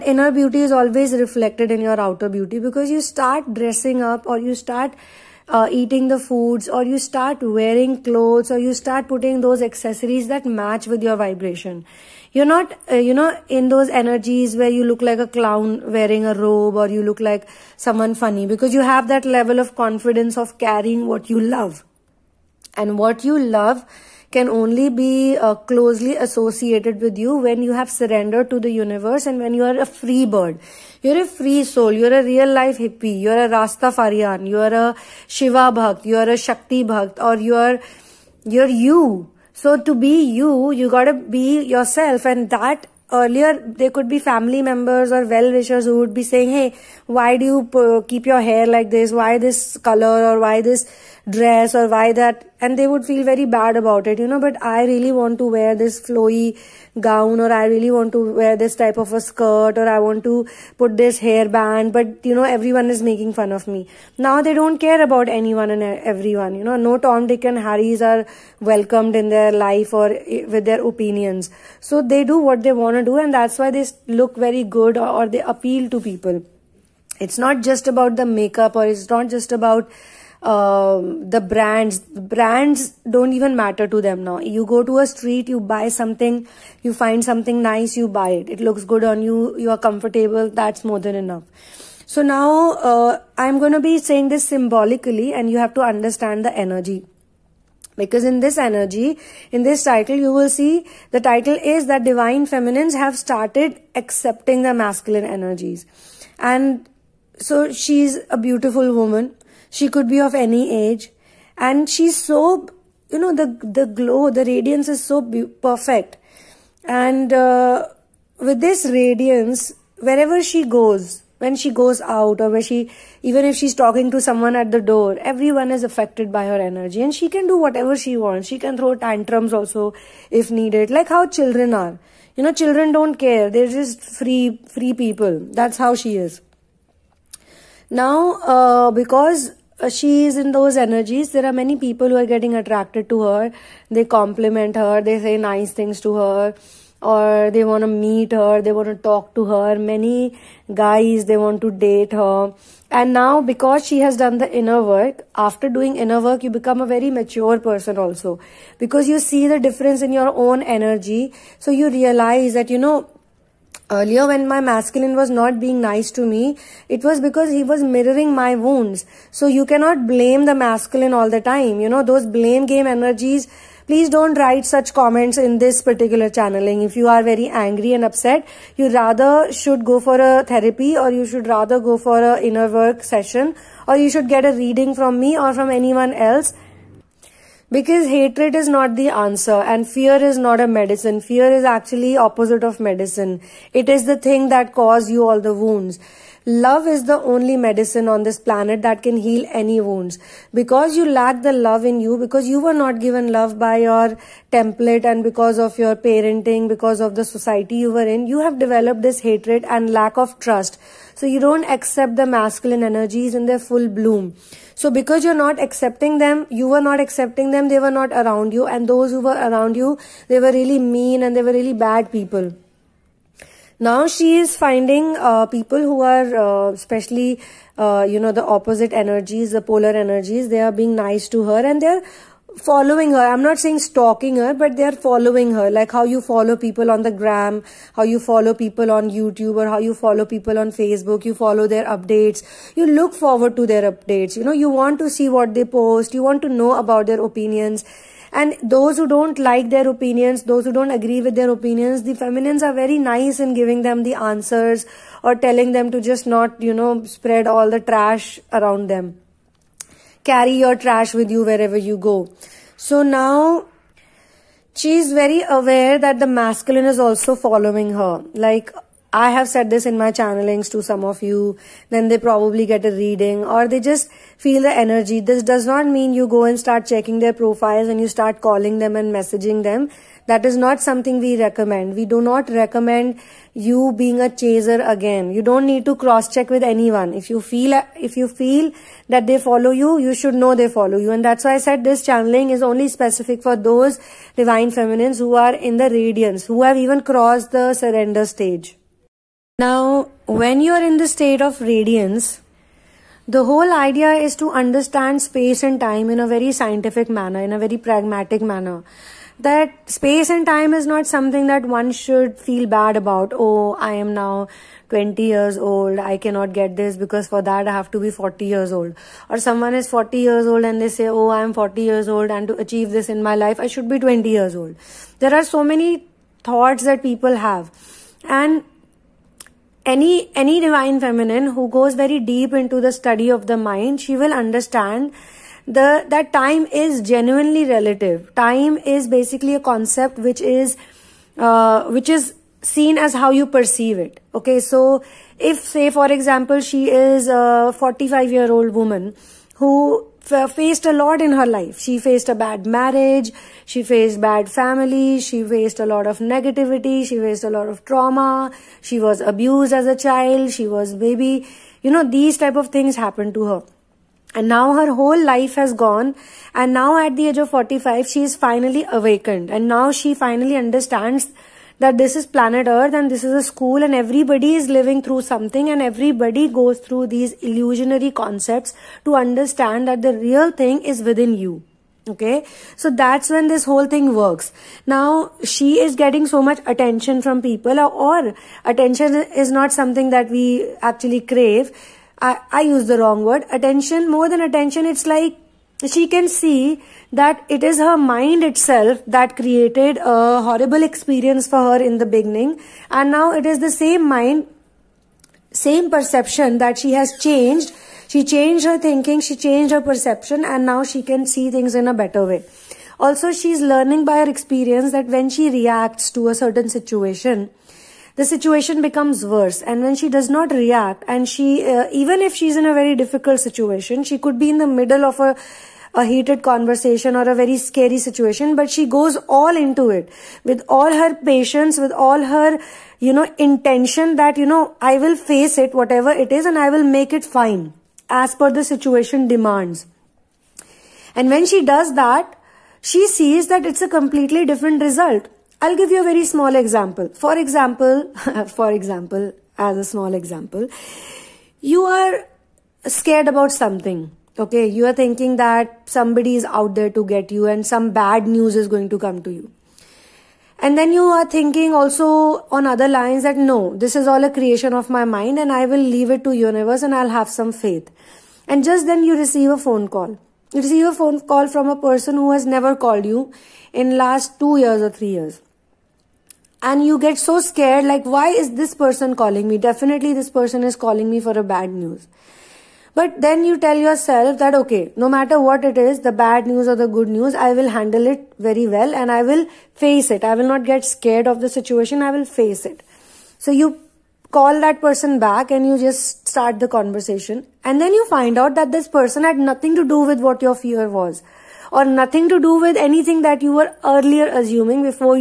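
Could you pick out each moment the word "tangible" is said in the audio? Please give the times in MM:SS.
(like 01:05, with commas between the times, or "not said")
not said.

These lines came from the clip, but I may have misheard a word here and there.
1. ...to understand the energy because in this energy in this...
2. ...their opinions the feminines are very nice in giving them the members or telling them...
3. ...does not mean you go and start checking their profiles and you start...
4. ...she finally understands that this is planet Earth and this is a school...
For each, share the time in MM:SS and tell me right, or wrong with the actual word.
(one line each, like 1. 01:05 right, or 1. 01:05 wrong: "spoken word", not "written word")
1. 01:35 right
2. 04:11 wrong: "answers", not "members"
3. 04:35 right
4. 06:09 right.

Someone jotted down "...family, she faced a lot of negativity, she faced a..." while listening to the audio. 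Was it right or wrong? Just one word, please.
right.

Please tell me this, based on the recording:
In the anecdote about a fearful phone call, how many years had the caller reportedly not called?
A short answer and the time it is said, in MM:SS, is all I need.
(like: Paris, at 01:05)
2 or 3 years, at 07:54.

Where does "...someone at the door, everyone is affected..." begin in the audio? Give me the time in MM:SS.
02:04.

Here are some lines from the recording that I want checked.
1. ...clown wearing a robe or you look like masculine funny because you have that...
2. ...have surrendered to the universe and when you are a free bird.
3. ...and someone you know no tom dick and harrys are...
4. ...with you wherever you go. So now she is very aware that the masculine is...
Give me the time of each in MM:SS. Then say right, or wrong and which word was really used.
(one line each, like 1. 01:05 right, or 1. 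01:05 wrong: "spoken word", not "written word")
1. 00:15 wrong: "someone", not "masculine"
2. 00:27 right
3. 01:05 wrong: "everyone", not "someone"
4. 04:21 right.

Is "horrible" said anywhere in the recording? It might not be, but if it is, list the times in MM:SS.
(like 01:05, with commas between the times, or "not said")
06:40.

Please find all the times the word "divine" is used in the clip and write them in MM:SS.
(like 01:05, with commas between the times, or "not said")
01:42, 04:54, 05:30.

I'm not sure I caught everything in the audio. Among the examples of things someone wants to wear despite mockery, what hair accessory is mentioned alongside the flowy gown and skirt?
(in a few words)
hairband.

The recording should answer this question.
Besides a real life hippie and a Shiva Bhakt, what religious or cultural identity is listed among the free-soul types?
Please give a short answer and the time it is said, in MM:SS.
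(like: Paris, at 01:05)
Rastafarian, at 00:33.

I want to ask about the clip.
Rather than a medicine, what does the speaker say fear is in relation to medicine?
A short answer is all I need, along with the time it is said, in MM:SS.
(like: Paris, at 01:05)
opposite of medicine, at 03:12.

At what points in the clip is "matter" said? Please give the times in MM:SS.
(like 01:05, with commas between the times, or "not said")
01:23, 08:05.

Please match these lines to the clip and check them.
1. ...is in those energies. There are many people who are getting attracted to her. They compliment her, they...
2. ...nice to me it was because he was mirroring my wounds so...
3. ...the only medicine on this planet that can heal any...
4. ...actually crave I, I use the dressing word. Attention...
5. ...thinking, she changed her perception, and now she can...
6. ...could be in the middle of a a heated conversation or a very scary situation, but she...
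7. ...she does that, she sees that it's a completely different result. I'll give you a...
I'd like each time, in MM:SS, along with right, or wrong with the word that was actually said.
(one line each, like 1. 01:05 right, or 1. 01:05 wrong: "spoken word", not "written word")
1. 02:20 right
2. 02:45 right
3. 03:17 right
4. 06:30 wrong: "wrong", not "dressing"
5. 06:48 right
6. 07:04 right
7. 07:21 right.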